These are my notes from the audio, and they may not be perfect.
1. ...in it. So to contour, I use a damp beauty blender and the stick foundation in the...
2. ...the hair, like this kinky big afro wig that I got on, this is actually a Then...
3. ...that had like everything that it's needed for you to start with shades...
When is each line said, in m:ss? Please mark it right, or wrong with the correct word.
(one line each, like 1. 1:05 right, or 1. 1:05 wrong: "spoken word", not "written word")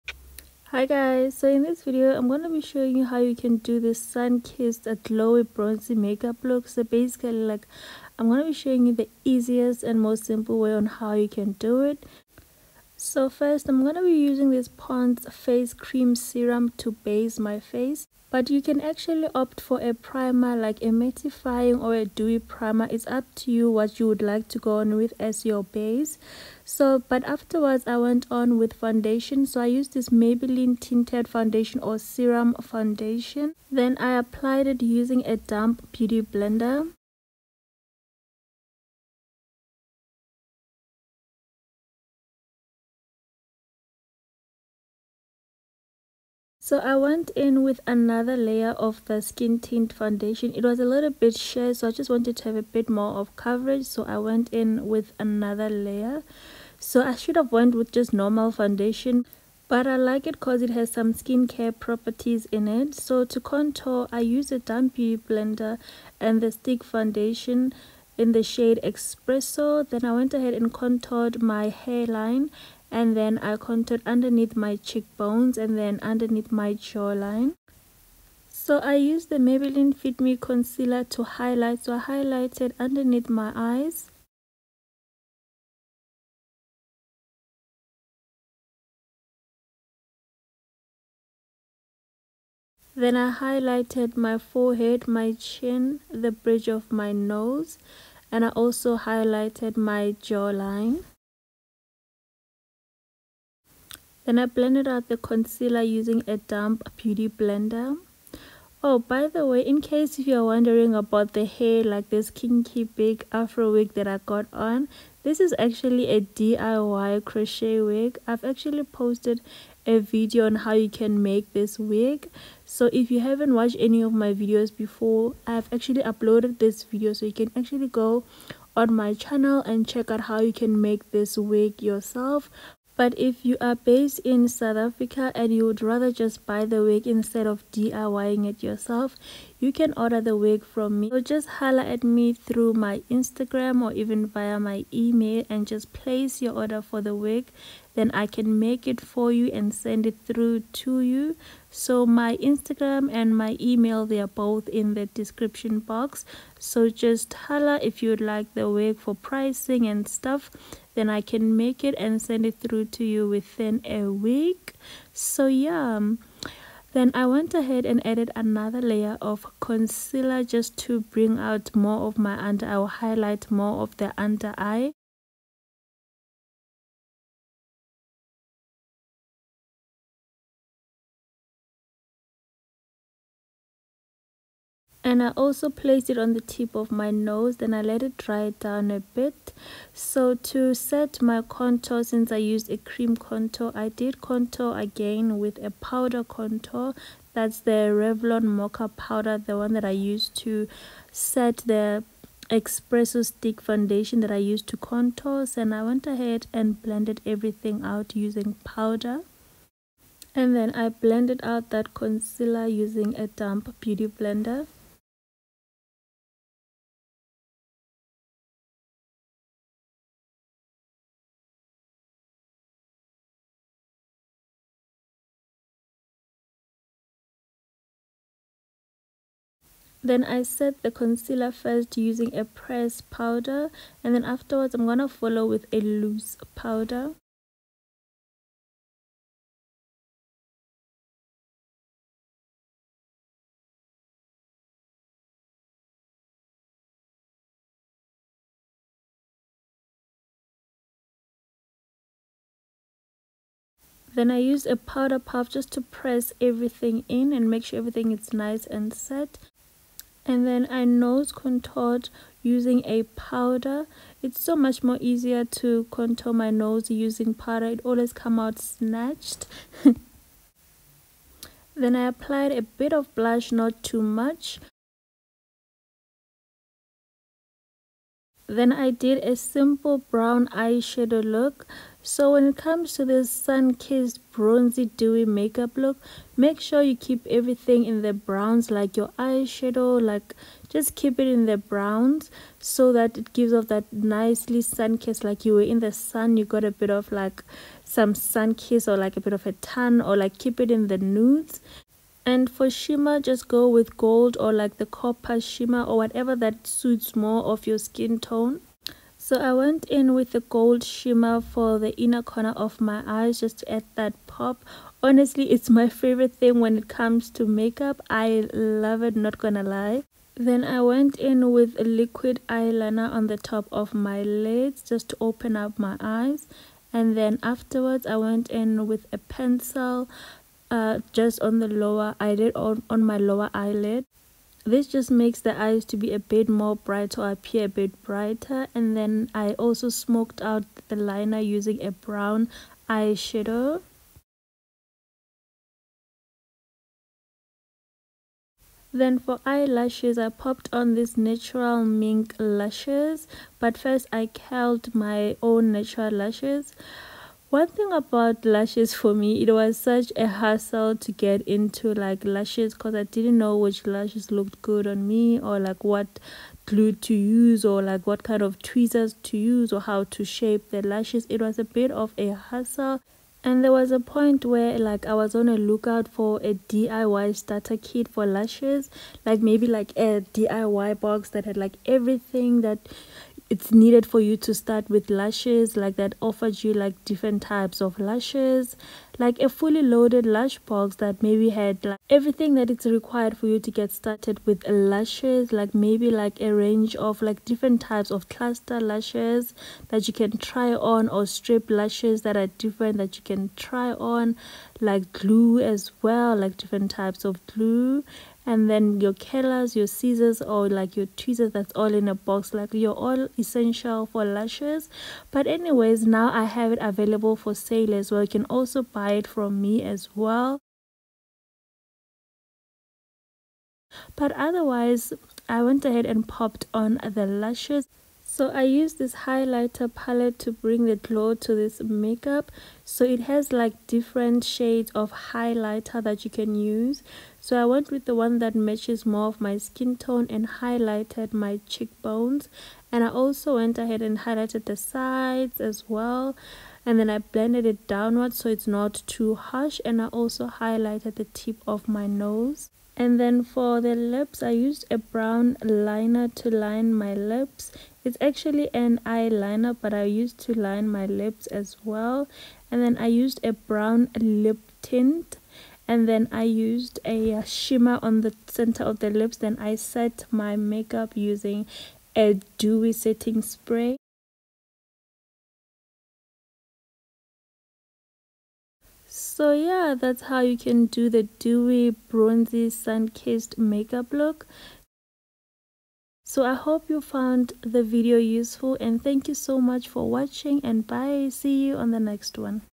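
1. 1:02 right
2. 1:51 wrong: "DIY", not "Then"
3. 6:21 wrong: "lashes", not "shades".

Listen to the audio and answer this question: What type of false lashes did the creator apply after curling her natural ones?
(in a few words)
natural mink lashes.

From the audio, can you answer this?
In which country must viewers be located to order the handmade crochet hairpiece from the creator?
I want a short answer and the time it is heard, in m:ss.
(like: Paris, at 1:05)
South Africa, at 2:14.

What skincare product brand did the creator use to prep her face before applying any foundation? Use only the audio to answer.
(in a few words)
Pond's.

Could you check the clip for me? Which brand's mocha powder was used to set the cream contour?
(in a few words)
Revlon.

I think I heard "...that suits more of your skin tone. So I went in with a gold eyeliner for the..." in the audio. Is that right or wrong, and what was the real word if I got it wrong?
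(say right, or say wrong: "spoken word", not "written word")
wrong: "shimmer", not "eyeliner".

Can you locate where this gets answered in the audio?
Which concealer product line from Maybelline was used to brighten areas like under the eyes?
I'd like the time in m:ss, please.
1:19.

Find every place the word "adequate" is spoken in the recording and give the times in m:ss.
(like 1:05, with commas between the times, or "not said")
not said.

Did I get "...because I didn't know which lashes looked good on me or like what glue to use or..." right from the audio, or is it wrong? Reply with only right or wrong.
right.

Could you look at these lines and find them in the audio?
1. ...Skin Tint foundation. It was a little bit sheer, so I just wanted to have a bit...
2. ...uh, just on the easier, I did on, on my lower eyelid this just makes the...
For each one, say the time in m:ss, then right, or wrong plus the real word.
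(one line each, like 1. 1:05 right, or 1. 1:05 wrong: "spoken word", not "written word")
1. 0:49 right
2. 5:30 wrong: "lower", not "easier".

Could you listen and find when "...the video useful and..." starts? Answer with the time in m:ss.
8:07.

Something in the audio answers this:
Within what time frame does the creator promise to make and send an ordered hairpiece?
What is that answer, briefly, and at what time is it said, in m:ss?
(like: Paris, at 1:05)
a week, at 2:43.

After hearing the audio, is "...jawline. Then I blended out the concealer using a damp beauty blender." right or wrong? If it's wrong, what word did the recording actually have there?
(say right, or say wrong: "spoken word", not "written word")
right.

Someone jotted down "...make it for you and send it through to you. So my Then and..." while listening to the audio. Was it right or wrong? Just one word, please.
wrong.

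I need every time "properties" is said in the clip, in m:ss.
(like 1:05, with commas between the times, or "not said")
1:01.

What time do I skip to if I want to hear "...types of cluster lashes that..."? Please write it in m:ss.
6:37.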